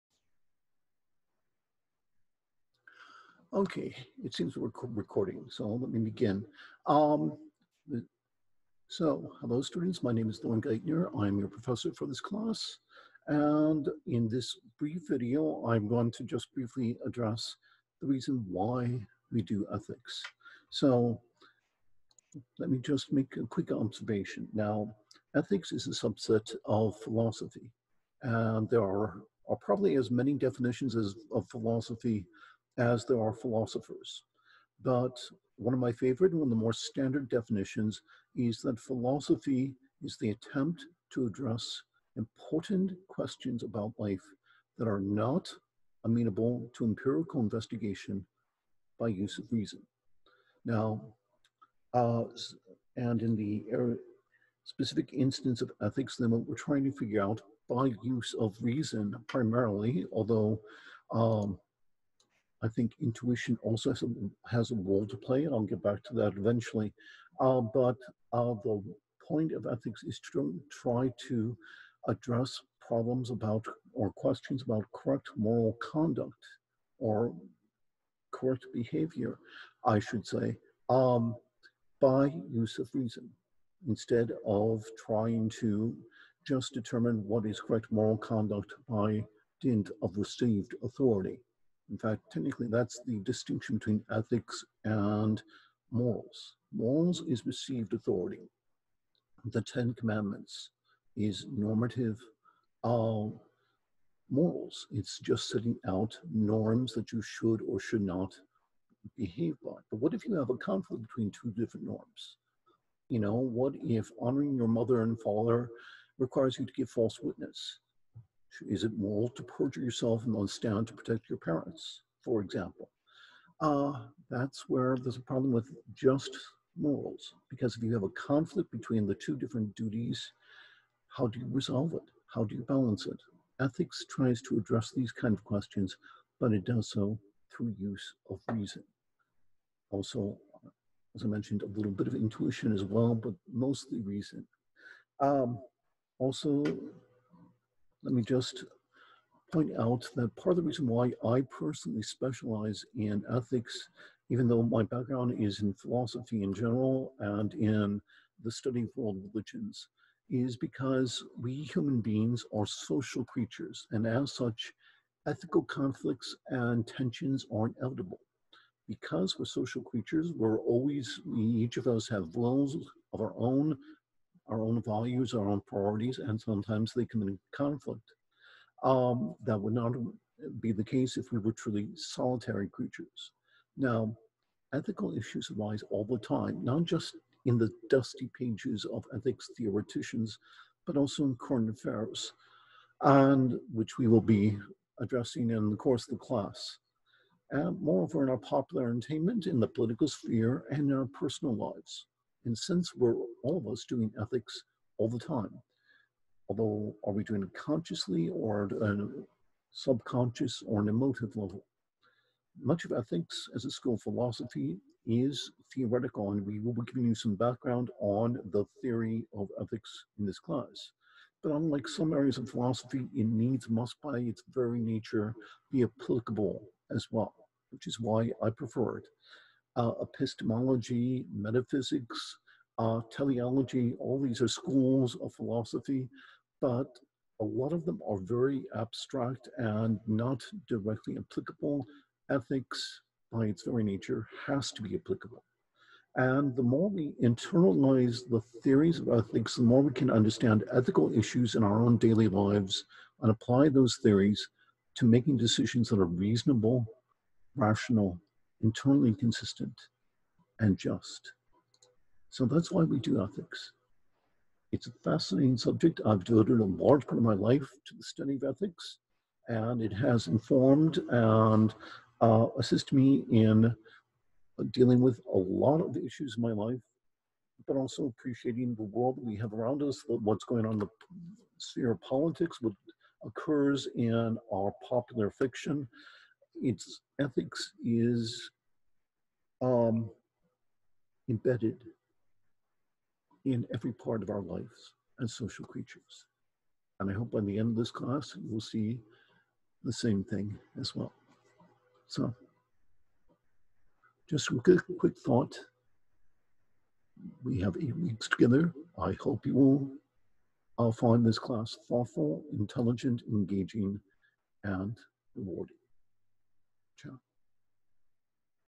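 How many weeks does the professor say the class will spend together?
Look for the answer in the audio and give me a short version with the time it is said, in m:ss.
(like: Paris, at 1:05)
8, at 5:07.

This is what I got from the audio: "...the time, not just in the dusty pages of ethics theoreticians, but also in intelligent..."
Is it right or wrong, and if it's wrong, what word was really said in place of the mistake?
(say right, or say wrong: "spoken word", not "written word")
wrong: "current", not "intelligent".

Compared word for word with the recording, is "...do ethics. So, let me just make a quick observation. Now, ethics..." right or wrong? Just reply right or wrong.
right.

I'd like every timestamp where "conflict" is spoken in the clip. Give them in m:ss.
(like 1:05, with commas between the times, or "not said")
1:50, 2:08, 2:45, 2:57.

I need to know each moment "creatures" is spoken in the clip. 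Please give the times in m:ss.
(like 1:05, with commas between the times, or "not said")
2:43, 2:49, 3:02, 4:55.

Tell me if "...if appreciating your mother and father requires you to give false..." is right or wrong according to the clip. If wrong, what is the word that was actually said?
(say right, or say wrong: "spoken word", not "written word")
wrong: "honoring", not "appreciating".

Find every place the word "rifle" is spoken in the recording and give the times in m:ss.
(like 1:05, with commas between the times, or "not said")
not said.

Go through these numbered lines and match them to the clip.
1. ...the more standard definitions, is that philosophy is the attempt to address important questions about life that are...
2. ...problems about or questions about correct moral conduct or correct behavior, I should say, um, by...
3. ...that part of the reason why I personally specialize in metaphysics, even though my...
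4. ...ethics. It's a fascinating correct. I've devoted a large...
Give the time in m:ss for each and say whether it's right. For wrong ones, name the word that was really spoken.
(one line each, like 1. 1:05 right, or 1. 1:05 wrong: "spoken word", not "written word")
1. 0:36 right
2. 1:12 right
3. 2:30 wrong: "ethics", not "metaphysics"
4. 4:23 wrong: "subject", not "correct".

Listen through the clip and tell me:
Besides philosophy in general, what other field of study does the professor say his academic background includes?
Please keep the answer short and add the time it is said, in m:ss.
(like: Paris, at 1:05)
world religions, at 2:38.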